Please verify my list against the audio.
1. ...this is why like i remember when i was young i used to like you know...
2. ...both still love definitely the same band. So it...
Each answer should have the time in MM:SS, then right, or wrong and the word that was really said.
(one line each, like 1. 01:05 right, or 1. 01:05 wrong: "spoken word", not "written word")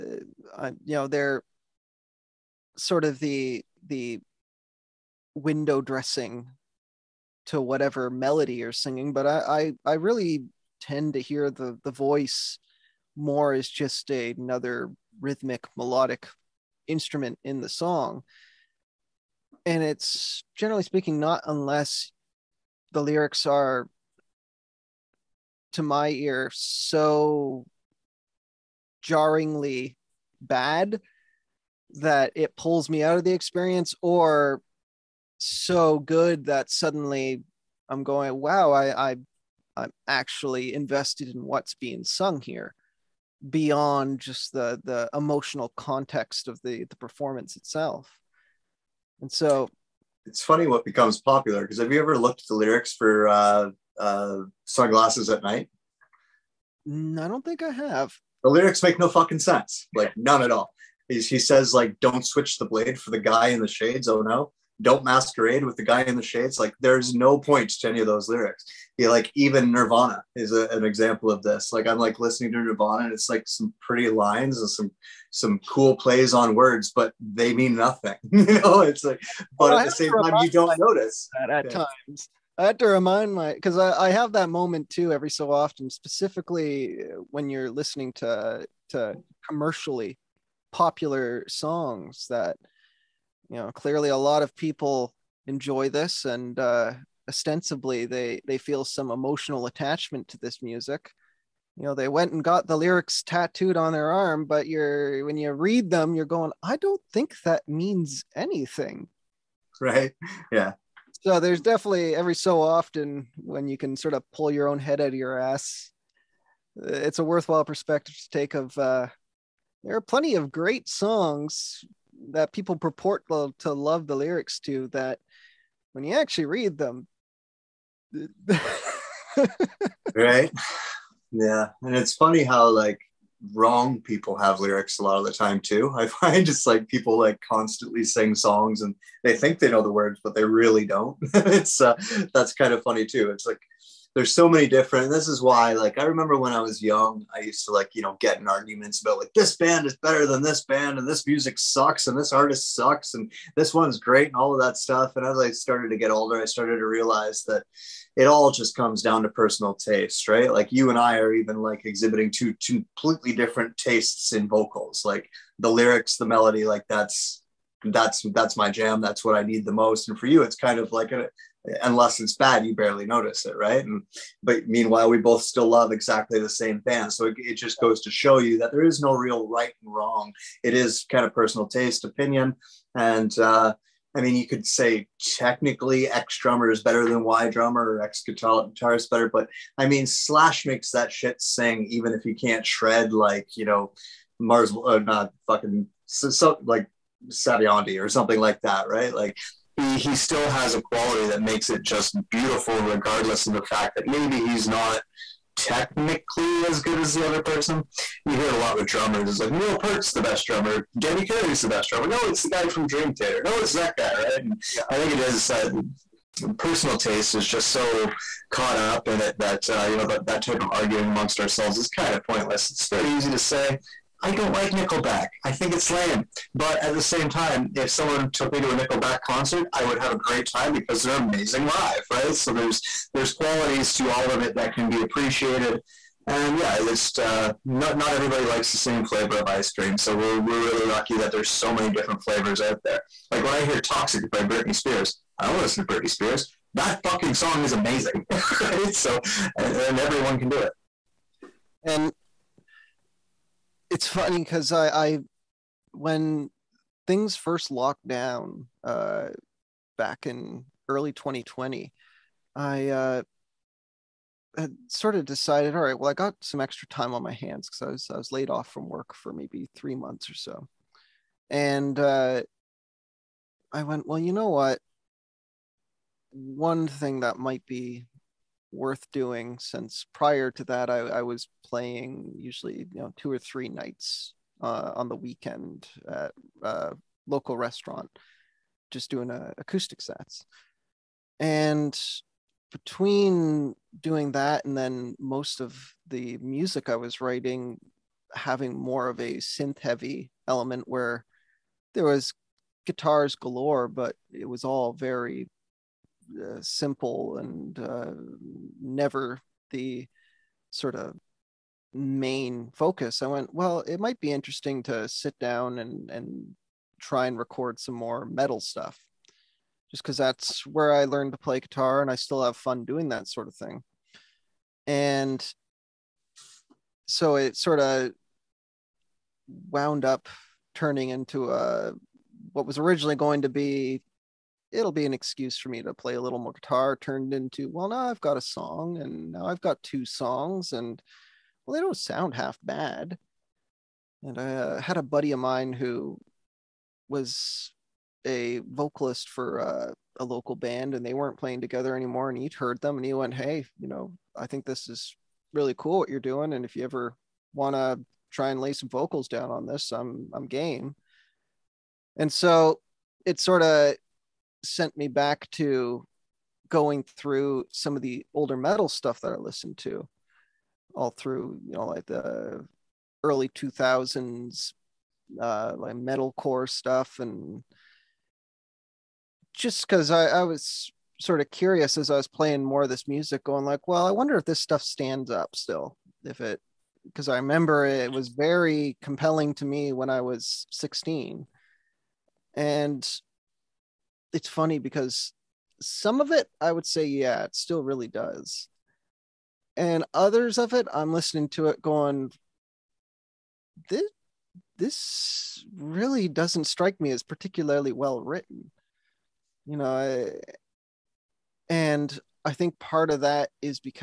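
1. 02:25 right
2. 02:55 wrong: "exactly", not "definitely".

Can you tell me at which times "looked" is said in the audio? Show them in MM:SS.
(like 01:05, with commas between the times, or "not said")
00:52.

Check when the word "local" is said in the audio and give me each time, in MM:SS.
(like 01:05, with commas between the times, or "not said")
04:47, 05:50.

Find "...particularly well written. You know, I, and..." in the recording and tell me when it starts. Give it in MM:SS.
06:47.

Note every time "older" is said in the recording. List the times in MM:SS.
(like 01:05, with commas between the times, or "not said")
02:36, 06:08.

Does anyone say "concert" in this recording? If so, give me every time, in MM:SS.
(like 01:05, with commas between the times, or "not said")
03:49.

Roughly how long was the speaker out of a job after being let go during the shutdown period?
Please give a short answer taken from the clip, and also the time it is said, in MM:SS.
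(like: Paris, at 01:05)
3 months, at 04:29.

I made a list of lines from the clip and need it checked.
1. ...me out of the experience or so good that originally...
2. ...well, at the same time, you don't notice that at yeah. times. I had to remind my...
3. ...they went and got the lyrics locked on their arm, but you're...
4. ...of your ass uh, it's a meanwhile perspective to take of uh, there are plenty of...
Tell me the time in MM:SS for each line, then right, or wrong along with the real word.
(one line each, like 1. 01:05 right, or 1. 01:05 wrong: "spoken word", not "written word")
1. 00:32 wrong: "suddenly", not "originally"
2. 01:19 right
3. 01:41 wrong: "tattooed", not "locked"
4. 01:55 wrong: "worthwhile", not "meanwhile".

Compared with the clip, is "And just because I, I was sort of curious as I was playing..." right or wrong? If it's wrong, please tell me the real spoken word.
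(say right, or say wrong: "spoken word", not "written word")
right.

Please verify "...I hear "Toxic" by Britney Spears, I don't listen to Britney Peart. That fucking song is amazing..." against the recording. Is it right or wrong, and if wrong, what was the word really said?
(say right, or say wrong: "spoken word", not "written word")
wrong: "Spears", not "Peart".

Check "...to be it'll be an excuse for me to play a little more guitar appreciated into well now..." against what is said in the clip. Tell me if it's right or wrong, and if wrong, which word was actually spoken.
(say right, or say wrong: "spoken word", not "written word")
wrong: "turned", not "appreciated".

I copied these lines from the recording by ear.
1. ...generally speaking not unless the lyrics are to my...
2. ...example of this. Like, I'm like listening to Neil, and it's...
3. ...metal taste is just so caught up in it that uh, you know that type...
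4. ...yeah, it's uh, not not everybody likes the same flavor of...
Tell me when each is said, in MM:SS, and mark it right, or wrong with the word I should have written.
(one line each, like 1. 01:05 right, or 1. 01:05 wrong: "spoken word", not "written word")
1. 00:20 right
2. 01:10 wrong: "Nirvana", not "Neil"
3. 03:36 wrong: "personal", not "metal"
4. 03:56 right.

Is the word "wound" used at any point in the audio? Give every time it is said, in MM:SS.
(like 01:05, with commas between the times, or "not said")
05:29.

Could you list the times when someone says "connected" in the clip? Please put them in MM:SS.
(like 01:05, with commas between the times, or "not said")
not said.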